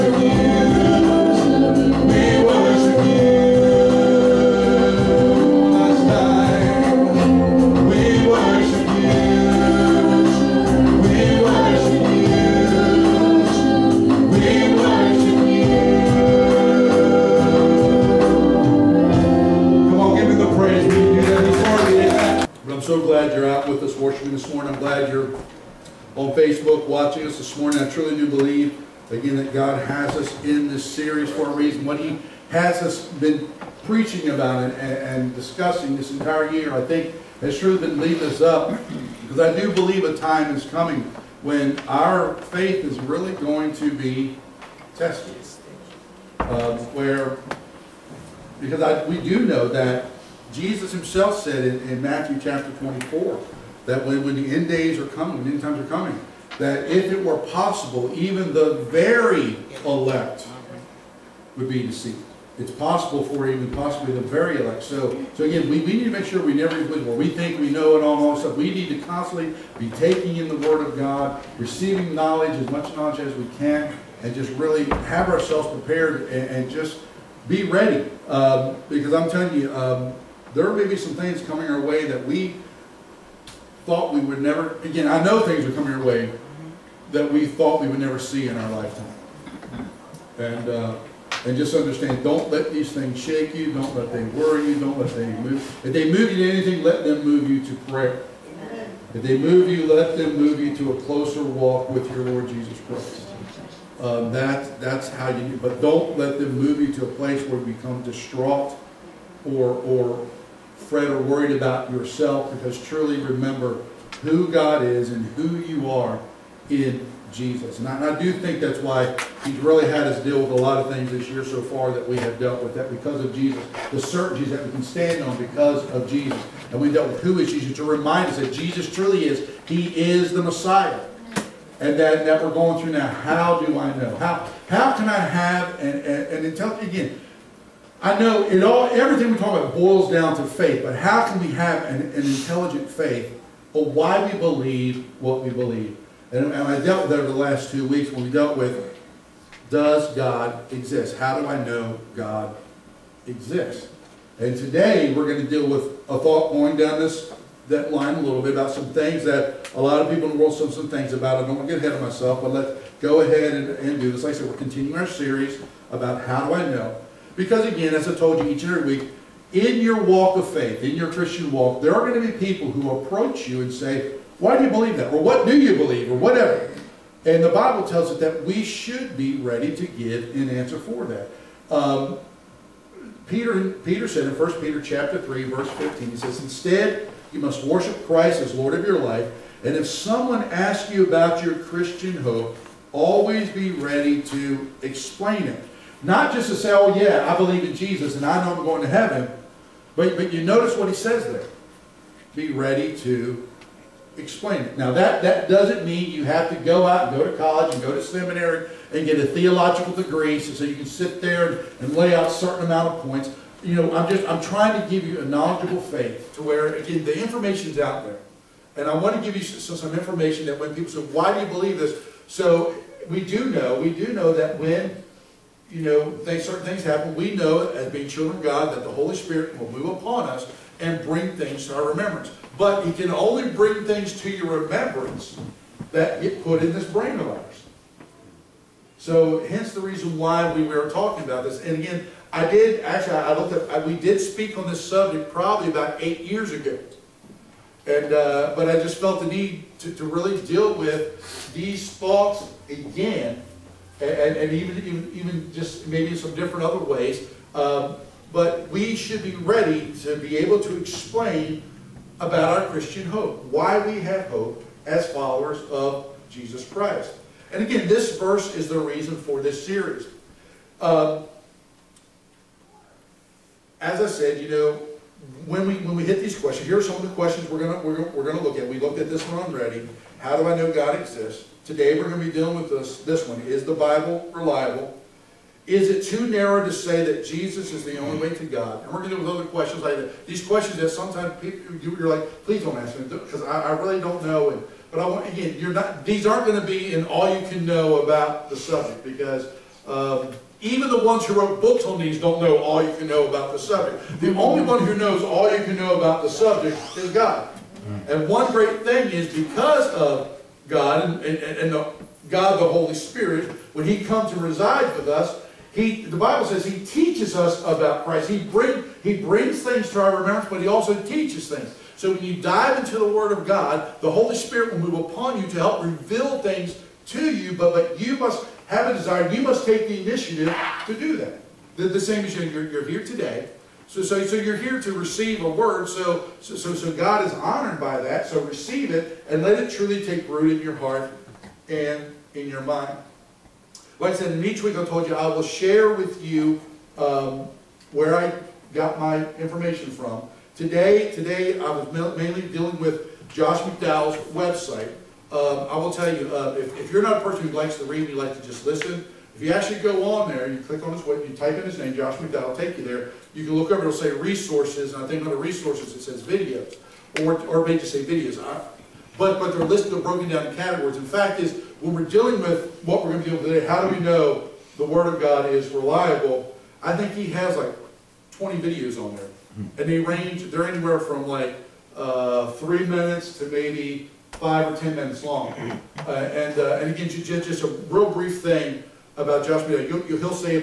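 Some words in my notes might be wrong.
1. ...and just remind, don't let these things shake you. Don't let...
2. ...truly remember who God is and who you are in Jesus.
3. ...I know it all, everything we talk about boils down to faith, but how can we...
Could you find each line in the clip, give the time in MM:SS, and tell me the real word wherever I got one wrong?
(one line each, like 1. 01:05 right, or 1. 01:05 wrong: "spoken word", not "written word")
1. 01:31 wrong: "understand", not "remind"
2. 01:52 right
3. 02:18 right.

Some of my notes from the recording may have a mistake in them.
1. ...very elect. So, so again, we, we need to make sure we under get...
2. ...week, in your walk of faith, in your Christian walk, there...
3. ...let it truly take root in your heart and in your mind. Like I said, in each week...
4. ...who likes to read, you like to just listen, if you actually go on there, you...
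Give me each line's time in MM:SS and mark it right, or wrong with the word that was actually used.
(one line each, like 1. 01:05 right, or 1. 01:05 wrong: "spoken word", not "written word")
1. 01:04 wrong: "never", not "under"
2. 02:48 right
3. 05:39 right
4. 05:57 right.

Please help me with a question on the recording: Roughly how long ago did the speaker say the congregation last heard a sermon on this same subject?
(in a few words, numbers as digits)
8 years.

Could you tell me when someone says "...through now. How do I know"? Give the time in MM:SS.
02:12.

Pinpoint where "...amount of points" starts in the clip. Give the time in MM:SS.
03:32.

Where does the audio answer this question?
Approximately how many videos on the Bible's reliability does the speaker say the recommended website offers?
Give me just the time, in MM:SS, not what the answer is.
06:18.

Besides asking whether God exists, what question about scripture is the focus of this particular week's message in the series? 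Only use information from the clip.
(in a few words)
Is the Bible reliable?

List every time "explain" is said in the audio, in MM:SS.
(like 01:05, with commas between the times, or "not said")
03:14, 03:24, 04:20.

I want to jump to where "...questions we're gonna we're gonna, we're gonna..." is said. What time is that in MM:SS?
04:37.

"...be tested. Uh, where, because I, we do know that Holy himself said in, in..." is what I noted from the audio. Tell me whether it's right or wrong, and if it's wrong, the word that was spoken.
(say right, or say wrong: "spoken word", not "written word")
wrong: "Jesus", not "Holy".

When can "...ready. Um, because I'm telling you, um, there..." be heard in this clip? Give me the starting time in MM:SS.
01:17.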